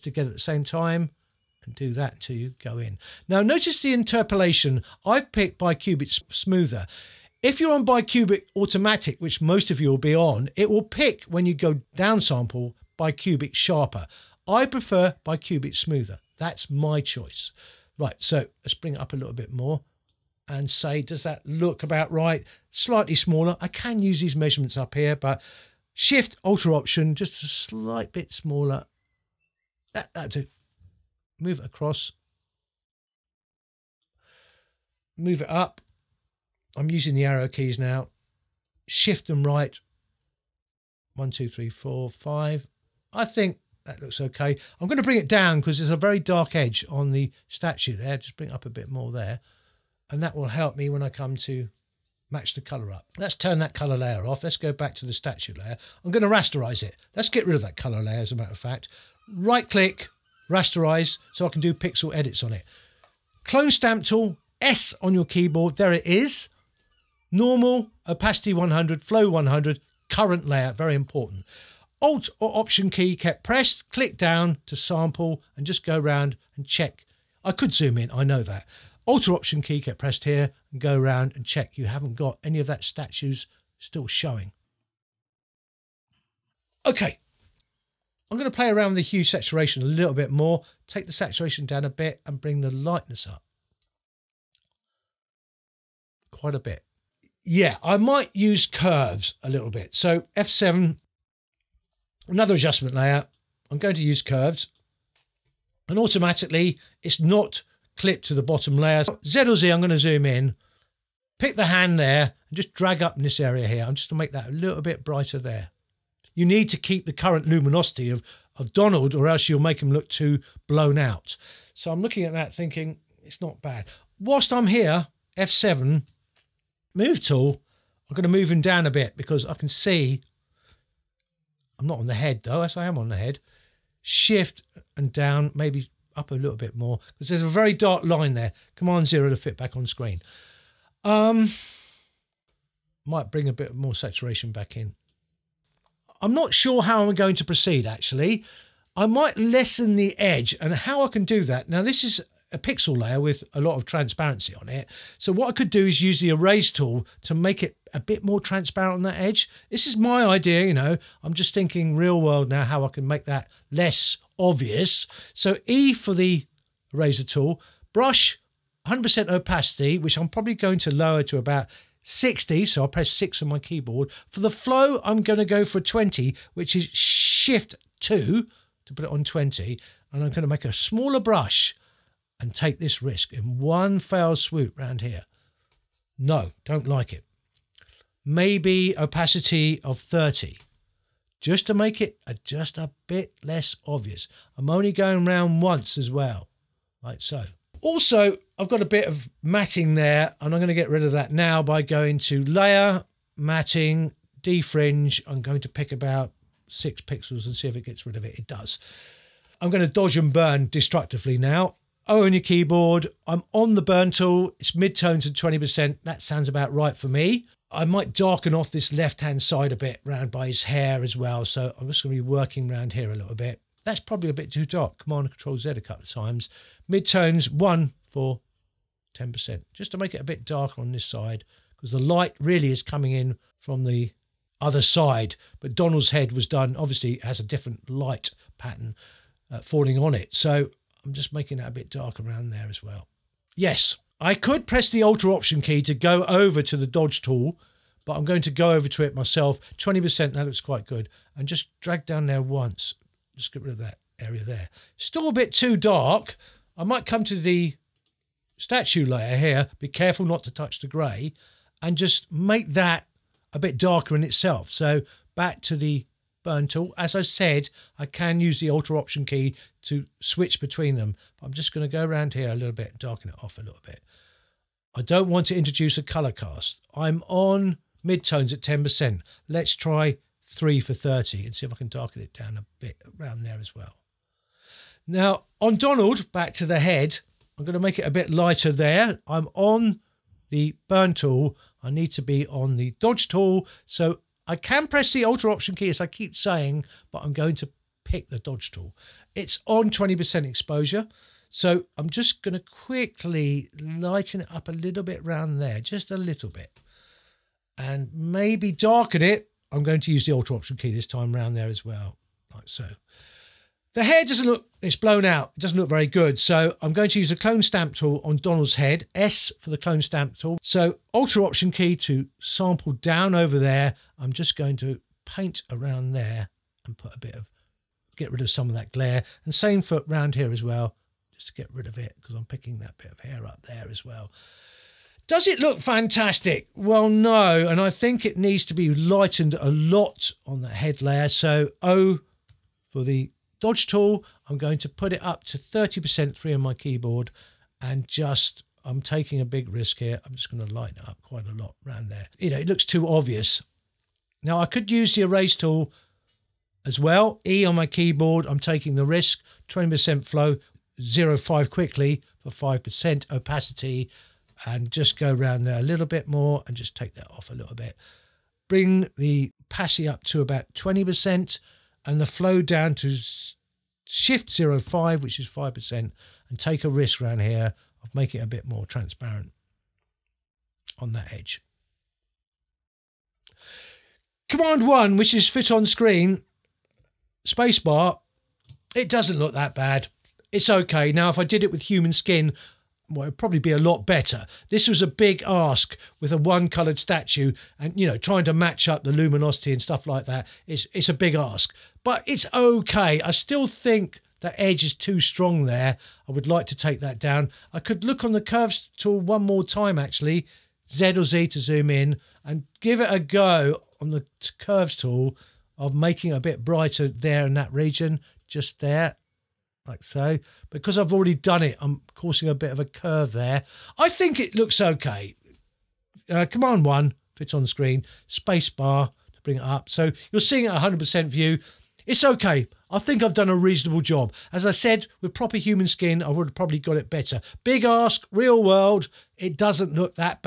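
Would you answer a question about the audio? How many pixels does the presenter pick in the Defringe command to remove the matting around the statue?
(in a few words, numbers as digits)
6.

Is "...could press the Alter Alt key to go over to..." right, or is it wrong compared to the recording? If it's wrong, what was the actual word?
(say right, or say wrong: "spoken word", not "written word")
wrong: "Option", not "Alt".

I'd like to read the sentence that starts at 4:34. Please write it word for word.
I don't want to introduce a color cast.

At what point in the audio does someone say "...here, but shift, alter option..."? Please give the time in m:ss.
0:24.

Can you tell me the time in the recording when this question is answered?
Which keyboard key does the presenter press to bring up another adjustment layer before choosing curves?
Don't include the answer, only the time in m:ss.
1:39.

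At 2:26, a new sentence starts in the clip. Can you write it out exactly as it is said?
I'm not sure how I'm going to proceed actually.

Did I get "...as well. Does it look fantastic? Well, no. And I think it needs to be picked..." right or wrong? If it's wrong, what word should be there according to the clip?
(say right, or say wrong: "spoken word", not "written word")
wrong: "lightened", not "picked".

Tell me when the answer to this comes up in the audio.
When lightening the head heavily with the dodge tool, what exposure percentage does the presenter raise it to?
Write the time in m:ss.
5:44.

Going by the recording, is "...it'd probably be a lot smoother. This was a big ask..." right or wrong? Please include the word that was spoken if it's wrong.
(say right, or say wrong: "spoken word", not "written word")
wrong: "better", not "smoother".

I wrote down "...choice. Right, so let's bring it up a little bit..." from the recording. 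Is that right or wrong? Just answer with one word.
right.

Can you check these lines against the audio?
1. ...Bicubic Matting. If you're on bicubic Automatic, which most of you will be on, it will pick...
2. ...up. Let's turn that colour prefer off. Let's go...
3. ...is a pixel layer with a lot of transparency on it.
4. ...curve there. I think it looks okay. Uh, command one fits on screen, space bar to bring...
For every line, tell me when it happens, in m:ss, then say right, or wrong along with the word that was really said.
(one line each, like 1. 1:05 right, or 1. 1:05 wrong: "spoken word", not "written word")
1. 0:05 wrong: "Smoother", not "Matting"
2. 0:52 wrong: "layer", not "prefer"
3. 2:32 right
4. 7:02 right.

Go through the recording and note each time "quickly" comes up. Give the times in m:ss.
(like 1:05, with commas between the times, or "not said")
5:02, 6:01.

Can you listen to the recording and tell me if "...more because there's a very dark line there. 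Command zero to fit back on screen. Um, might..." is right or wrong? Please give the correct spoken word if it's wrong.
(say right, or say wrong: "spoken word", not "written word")
right.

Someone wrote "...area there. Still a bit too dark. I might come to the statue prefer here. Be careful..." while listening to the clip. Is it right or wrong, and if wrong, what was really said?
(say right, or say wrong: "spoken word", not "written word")
wrong: "layer", not "prefer".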